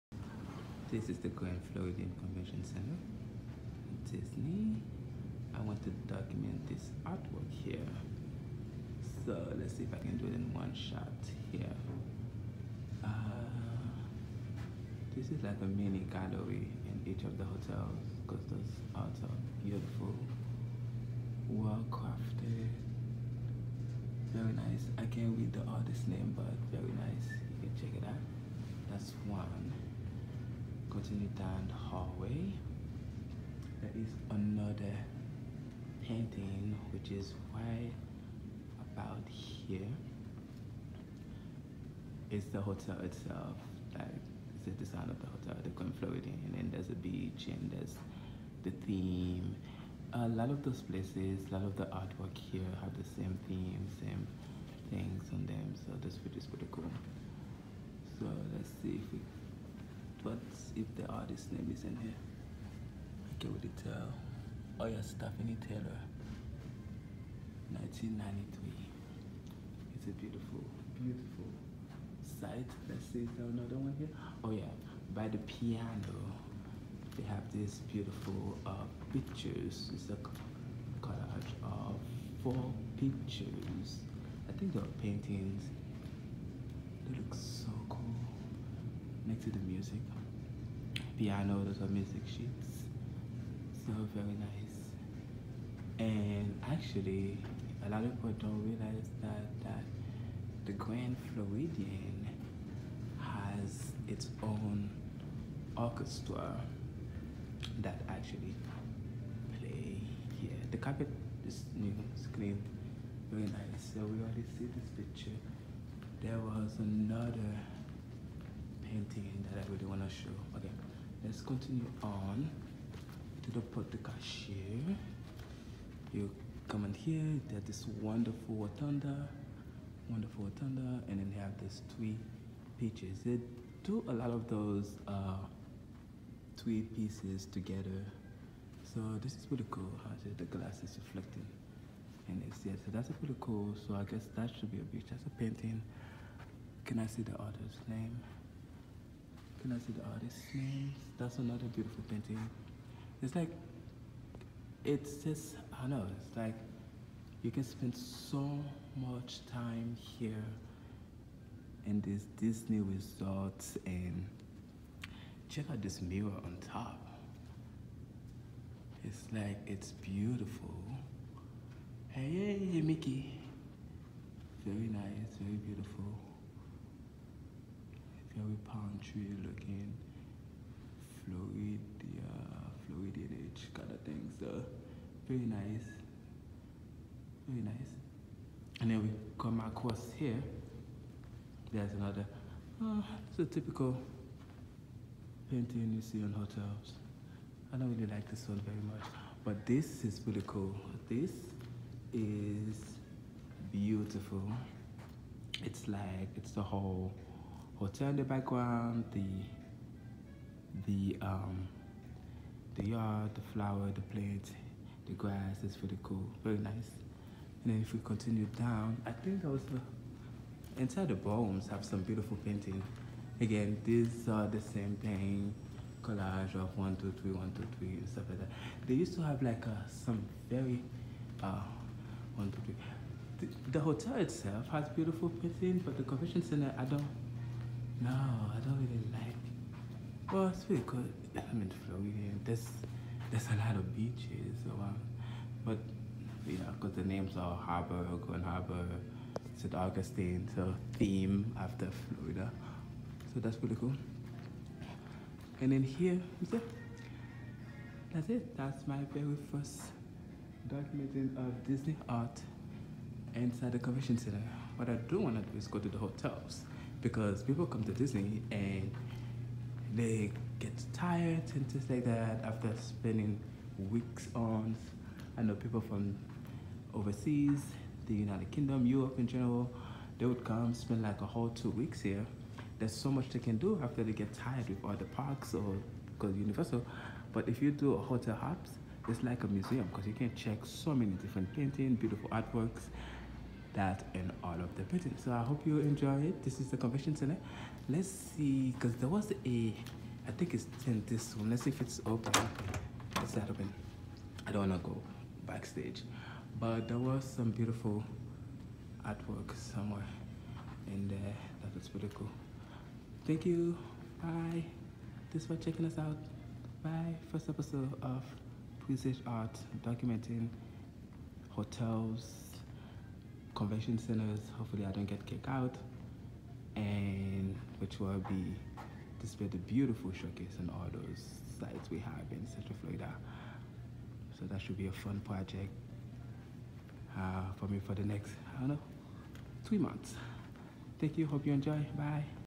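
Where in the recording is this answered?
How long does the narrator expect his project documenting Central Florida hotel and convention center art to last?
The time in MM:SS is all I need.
05:39.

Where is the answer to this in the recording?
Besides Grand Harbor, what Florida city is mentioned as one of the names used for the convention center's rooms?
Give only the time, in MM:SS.
04:09.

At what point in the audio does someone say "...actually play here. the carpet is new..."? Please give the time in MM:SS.
01:48.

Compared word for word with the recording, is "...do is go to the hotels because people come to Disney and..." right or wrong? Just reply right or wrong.
right.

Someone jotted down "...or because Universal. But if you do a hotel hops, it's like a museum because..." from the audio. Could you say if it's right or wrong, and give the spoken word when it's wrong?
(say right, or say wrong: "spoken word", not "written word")
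right.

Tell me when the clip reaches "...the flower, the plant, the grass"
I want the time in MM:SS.
03:33.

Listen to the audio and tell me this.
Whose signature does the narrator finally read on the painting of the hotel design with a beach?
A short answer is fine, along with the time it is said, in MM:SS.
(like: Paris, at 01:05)
Stephanie Taylor, at 01:05.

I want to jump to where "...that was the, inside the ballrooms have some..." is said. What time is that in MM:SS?
03:39.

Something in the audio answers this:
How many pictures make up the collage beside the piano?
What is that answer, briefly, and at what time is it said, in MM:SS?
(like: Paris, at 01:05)
4, at 01:22.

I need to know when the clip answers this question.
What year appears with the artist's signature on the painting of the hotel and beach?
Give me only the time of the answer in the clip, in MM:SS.
01:07.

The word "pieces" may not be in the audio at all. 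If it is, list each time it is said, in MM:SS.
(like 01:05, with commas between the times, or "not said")
02:12, 02:16.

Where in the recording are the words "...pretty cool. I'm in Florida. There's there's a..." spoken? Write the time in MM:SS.
04:00.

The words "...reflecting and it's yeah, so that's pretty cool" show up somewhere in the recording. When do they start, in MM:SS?
02:21.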